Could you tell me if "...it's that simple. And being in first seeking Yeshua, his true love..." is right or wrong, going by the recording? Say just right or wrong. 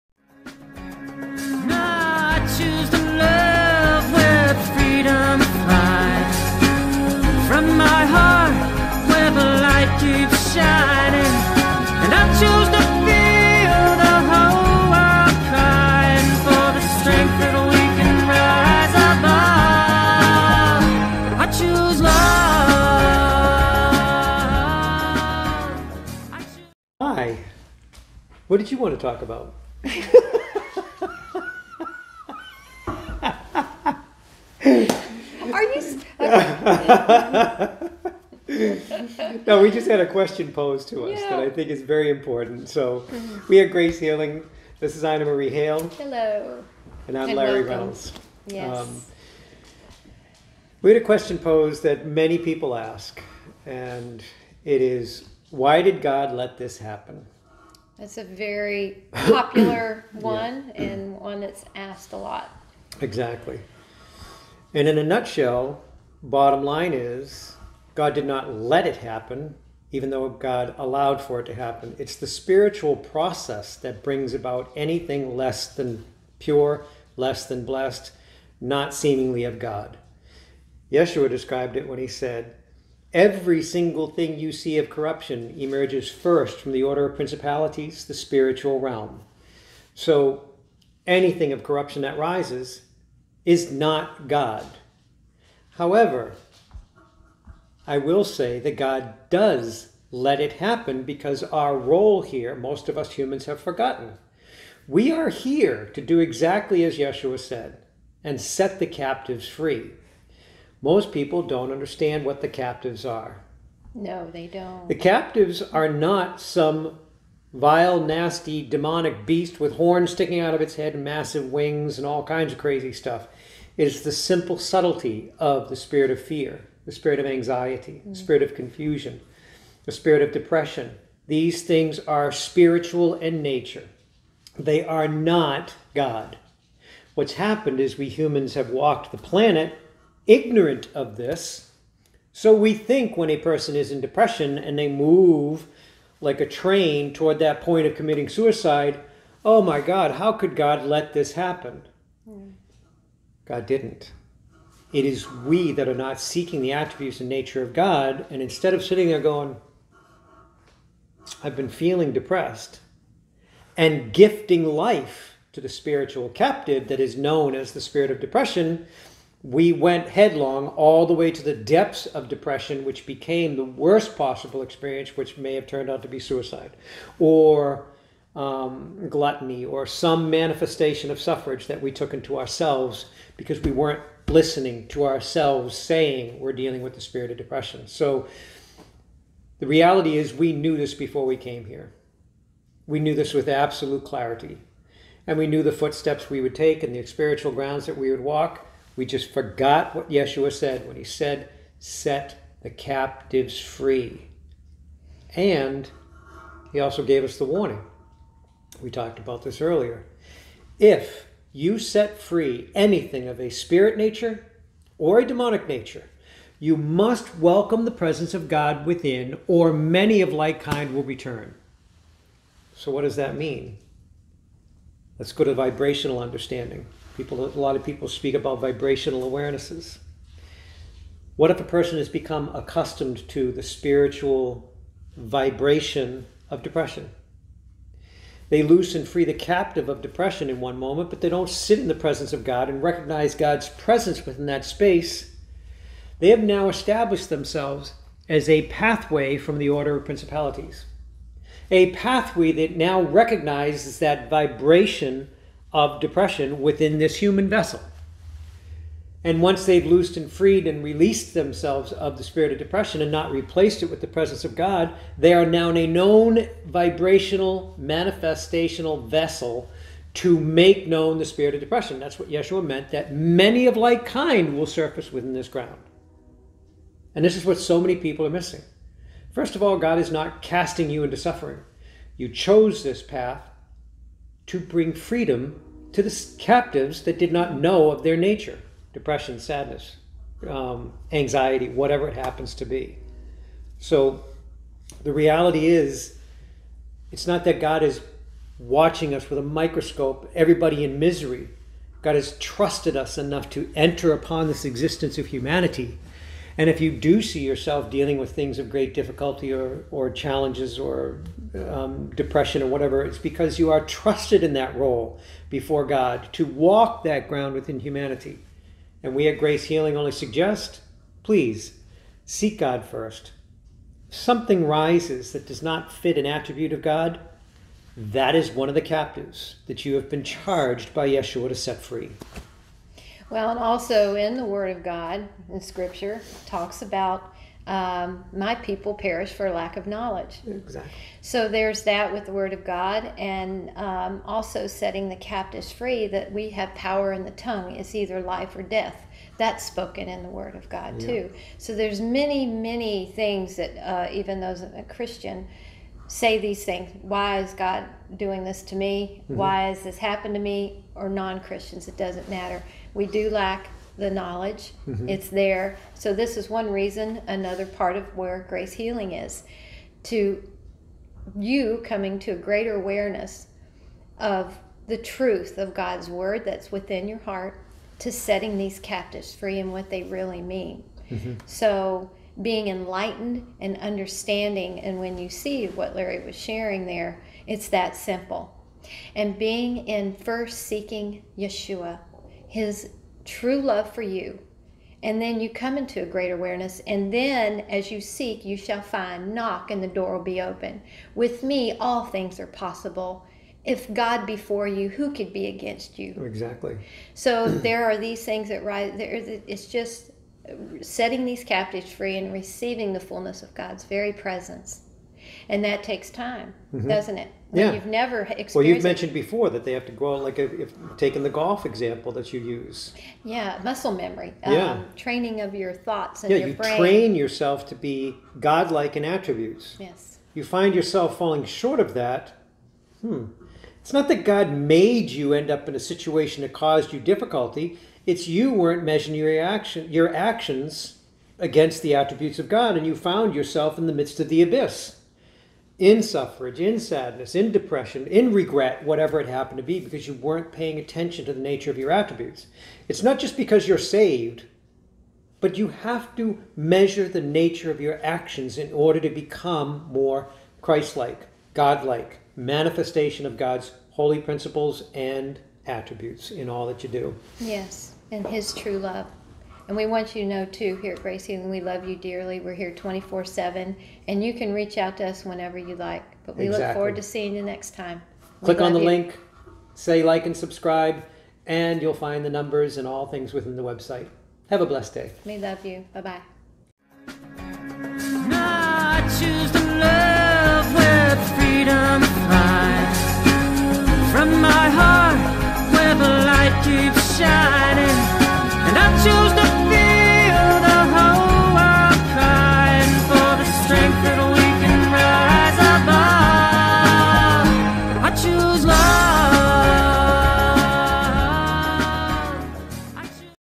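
right.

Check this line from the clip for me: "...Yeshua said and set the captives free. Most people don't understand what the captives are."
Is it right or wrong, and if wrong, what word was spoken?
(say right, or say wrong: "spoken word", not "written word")
right.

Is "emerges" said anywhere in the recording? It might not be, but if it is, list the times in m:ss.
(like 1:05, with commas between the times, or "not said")
1:25.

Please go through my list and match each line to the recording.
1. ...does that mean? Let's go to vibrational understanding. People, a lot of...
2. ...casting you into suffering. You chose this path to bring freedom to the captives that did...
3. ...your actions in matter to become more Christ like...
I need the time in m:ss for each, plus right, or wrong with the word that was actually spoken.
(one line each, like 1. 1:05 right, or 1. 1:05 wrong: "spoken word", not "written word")
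1. 3:43 right
2. 4:40 right
3. 7:37 wrong: "order", not "matter".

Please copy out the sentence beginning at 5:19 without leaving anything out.
And we at Grace Healing only suggest please seek God first.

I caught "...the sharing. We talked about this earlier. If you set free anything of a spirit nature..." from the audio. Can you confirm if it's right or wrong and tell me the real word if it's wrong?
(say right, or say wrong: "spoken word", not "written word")
wrong: "warning", not "sharing".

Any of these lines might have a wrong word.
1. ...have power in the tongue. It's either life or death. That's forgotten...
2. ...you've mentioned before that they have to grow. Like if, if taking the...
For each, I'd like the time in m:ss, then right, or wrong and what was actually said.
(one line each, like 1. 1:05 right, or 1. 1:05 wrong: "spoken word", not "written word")
1. 5:46 wrong: "spoken", not "forgotten"
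2. 6:58 right.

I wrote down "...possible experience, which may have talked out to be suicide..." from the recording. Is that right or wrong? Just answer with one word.
wrong.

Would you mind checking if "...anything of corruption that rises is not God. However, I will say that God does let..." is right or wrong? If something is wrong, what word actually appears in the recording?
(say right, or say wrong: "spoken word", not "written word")
right.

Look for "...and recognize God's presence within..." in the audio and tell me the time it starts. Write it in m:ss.
4:02.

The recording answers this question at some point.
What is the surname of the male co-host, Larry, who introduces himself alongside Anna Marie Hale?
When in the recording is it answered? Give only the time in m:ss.
0:47.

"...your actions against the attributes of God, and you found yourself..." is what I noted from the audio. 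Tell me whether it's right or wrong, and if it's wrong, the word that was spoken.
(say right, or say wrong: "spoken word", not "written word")
right.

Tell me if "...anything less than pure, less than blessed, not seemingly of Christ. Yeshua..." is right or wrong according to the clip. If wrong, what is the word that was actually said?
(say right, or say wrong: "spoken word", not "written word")
wrong: "God", not "Christ".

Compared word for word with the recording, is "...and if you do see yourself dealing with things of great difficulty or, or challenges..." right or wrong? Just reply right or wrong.
right.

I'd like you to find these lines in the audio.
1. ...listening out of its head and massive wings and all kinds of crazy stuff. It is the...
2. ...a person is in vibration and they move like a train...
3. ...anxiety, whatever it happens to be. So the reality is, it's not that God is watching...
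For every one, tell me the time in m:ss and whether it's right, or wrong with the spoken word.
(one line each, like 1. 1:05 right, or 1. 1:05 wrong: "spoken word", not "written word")
1. 2:00 wrong: "sticking", not "listening"
2. 2:23 wrong: "depression", not "vibration"
3. 4:51 right.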